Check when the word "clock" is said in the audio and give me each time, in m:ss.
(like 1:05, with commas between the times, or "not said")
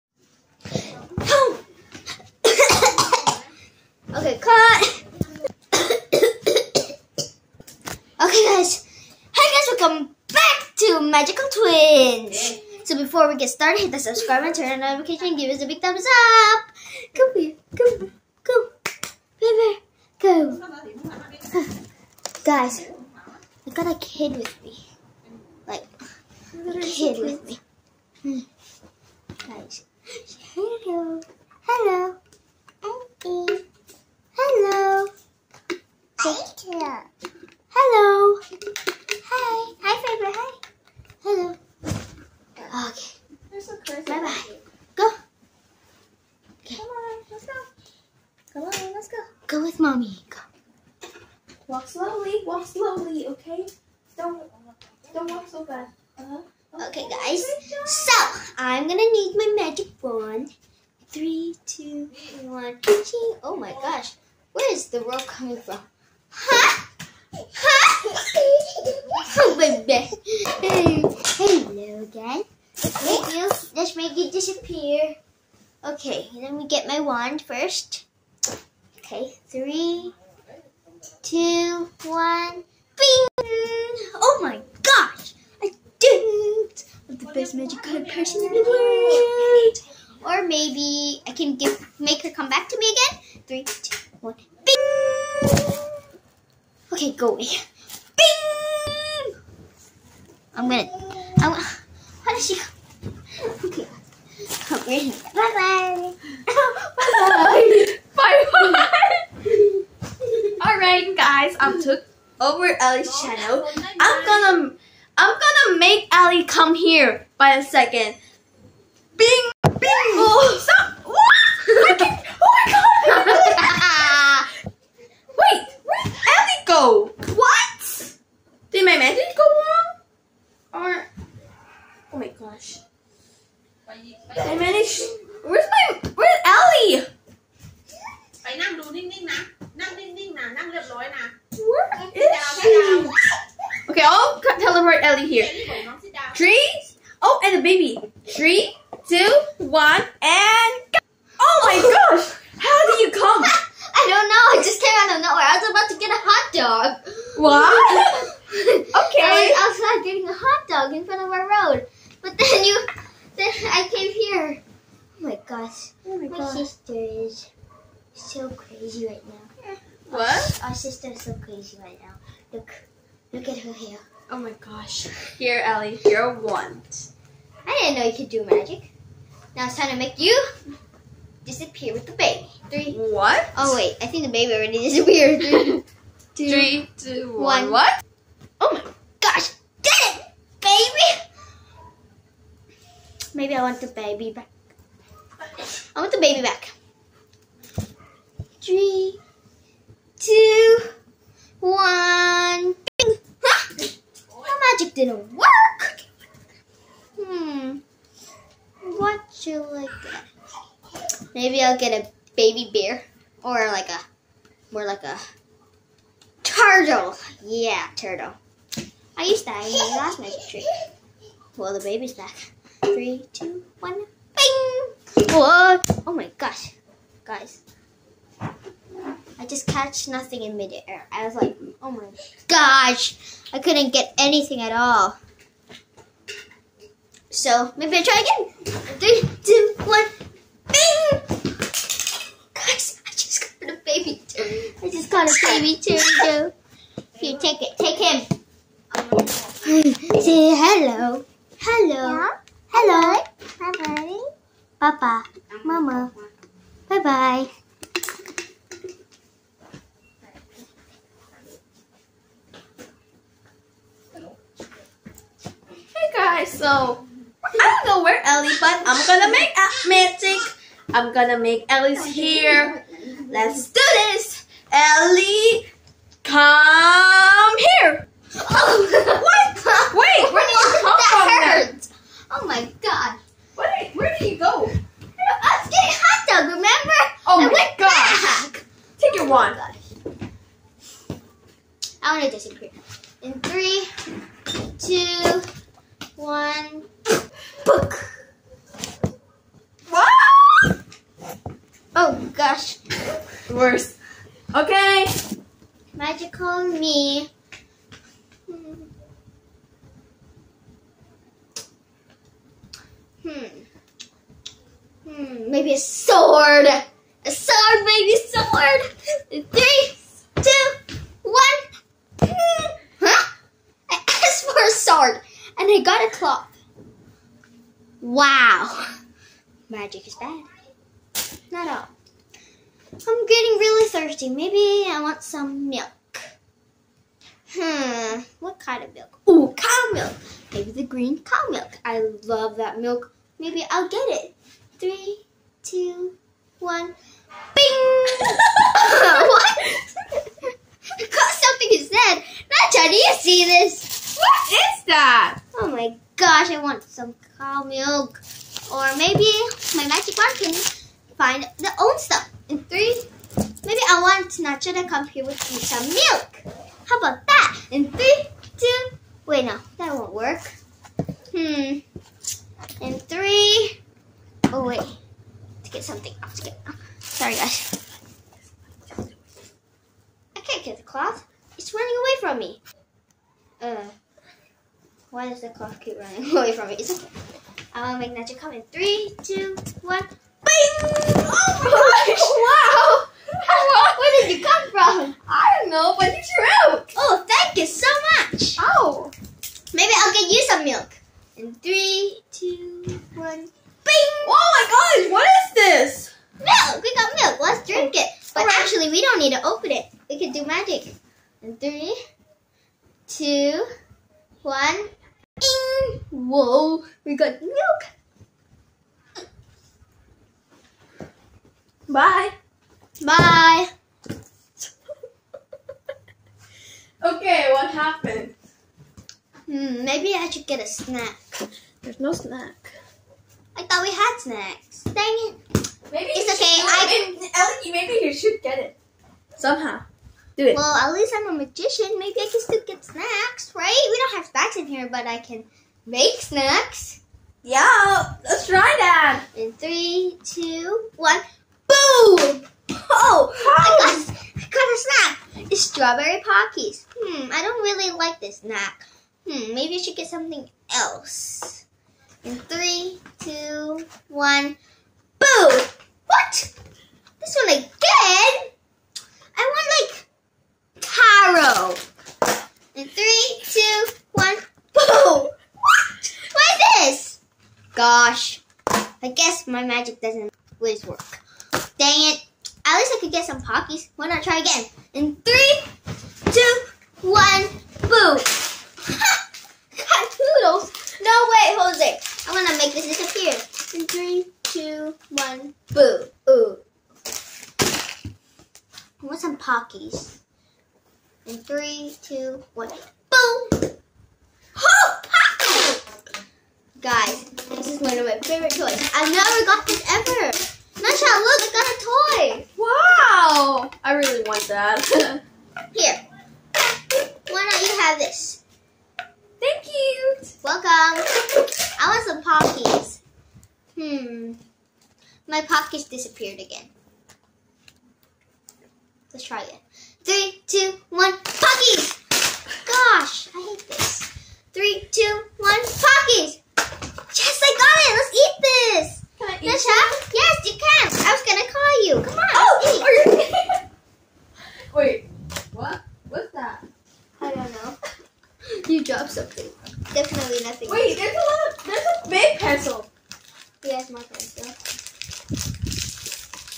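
6:25.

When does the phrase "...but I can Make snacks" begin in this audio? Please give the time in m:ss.
7:24.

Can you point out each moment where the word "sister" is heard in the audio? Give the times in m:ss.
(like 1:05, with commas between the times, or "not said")
2:46, 2:50.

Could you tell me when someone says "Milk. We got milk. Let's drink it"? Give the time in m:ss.
6:46.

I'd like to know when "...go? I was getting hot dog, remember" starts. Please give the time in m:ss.
4:44.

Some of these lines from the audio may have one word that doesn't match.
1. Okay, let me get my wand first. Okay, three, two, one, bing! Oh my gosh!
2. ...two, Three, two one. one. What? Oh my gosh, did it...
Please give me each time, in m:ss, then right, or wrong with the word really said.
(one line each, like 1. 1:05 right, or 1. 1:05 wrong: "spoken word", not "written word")
1. 1:15 right
2. 3:06 right.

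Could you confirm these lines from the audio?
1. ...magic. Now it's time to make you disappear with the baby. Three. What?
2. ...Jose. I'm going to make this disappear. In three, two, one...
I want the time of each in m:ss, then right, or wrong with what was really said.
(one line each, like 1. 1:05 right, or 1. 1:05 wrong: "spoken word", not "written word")
1. 2:58 right
2. 8:11 right.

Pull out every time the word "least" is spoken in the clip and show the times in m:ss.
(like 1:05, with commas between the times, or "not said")
7:20, 8:02.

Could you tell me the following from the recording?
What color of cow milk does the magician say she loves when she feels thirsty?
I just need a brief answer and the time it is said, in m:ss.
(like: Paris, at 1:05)
green, at 5:40.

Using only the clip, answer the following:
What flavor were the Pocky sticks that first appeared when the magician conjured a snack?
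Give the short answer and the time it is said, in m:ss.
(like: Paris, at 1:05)
strawberry, at 7:35.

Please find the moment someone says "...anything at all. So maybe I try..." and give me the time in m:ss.
3:54.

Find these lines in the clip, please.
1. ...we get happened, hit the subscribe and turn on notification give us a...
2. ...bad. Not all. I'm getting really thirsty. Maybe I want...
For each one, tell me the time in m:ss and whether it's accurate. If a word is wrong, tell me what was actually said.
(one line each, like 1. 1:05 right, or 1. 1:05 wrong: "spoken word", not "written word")
1. 0:13 wrong: "started", not "happened"
2. 5:30 right.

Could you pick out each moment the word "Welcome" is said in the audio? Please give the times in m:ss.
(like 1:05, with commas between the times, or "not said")
0:09, 8:40.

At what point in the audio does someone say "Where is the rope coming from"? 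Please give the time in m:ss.
1:04.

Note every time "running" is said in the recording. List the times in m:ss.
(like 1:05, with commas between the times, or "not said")
6:21, 6:25.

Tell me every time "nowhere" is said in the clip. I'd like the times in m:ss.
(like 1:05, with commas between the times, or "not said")
2:35.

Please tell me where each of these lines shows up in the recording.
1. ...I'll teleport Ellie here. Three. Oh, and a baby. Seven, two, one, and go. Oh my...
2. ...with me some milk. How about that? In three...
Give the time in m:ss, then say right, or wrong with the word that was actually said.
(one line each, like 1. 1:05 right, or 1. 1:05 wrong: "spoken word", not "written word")
1. 2:24 wrong: "Three", not "Seven"
2. 6:05 right.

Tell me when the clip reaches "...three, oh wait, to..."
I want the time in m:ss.
6:13.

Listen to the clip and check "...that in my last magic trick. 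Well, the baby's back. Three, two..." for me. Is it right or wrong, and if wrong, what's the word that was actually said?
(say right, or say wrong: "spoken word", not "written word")
right.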